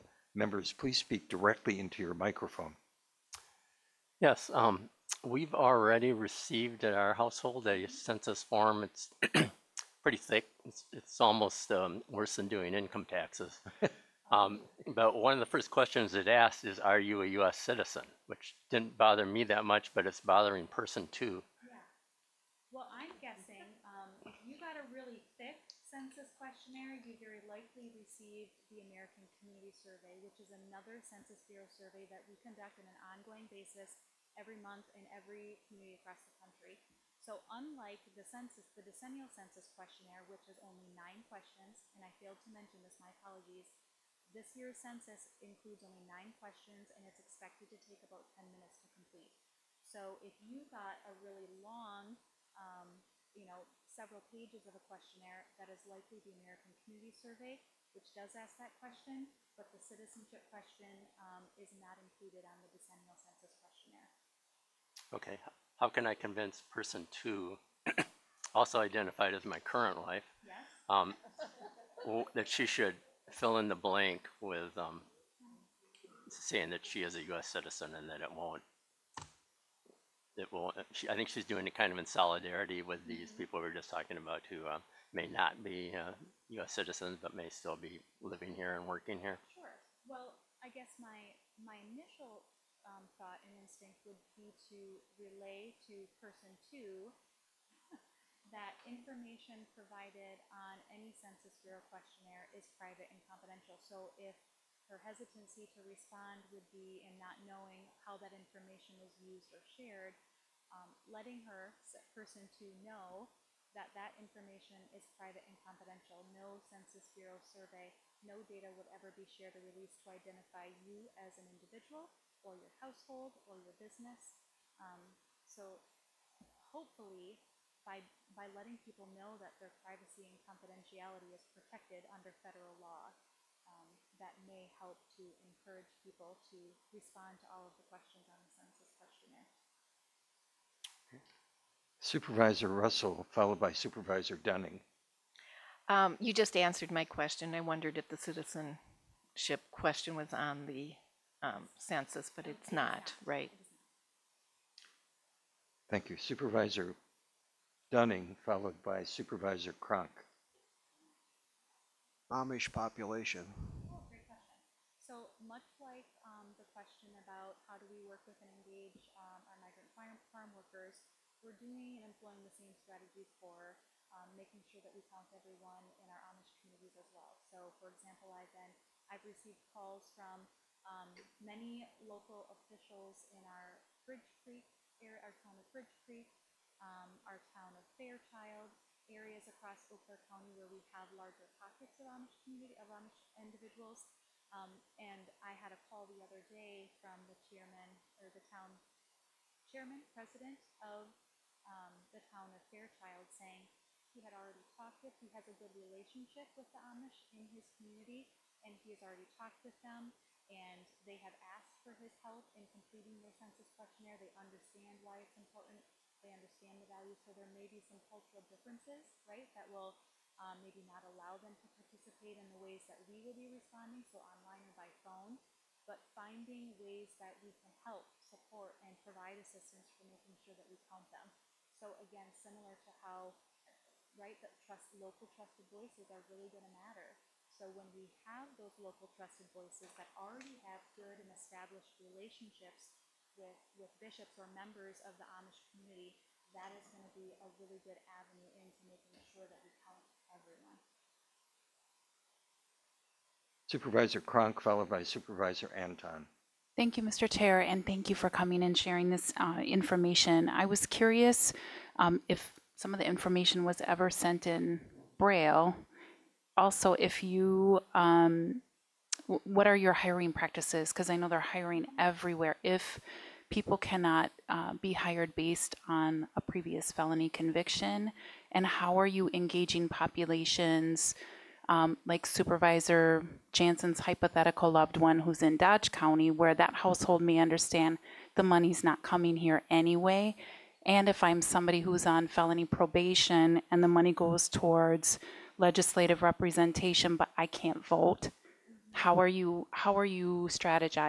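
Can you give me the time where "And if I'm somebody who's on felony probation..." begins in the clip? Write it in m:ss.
4:50.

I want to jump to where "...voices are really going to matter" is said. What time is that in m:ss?
3:55.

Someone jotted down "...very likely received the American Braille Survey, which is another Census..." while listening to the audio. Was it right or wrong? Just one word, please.
wrong.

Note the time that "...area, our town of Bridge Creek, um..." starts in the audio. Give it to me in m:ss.
3:05.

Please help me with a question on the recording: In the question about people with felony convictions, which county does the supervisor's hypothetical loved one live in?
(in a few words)
Dodge County.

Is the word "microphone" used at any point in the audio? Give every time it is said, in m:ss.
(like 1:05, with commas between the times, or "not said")
0:02.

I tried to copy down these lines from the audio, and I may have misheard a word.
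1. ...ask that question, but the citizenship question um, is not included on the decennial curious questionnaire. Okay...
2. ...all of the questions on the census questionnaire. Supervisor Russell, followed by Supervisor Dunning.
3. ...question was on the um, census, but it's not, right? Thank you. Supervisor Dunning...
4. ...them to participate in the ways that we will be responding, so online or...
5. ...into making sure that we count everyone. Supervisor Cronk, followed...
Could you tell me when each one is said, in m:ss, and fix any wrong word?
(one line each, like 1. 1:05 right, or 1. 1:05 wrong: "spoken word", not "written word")
1. 0:58 wrong: "census", not "curious"
2. 2:17 right
3. 2:29 right
4. 3:41 right
5. 4:08 right.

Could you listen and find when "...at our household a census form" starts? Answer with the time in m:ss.
0:06.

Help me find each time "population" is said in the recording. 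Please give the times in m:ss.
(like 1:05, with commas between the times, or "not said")
2:42, 4:39.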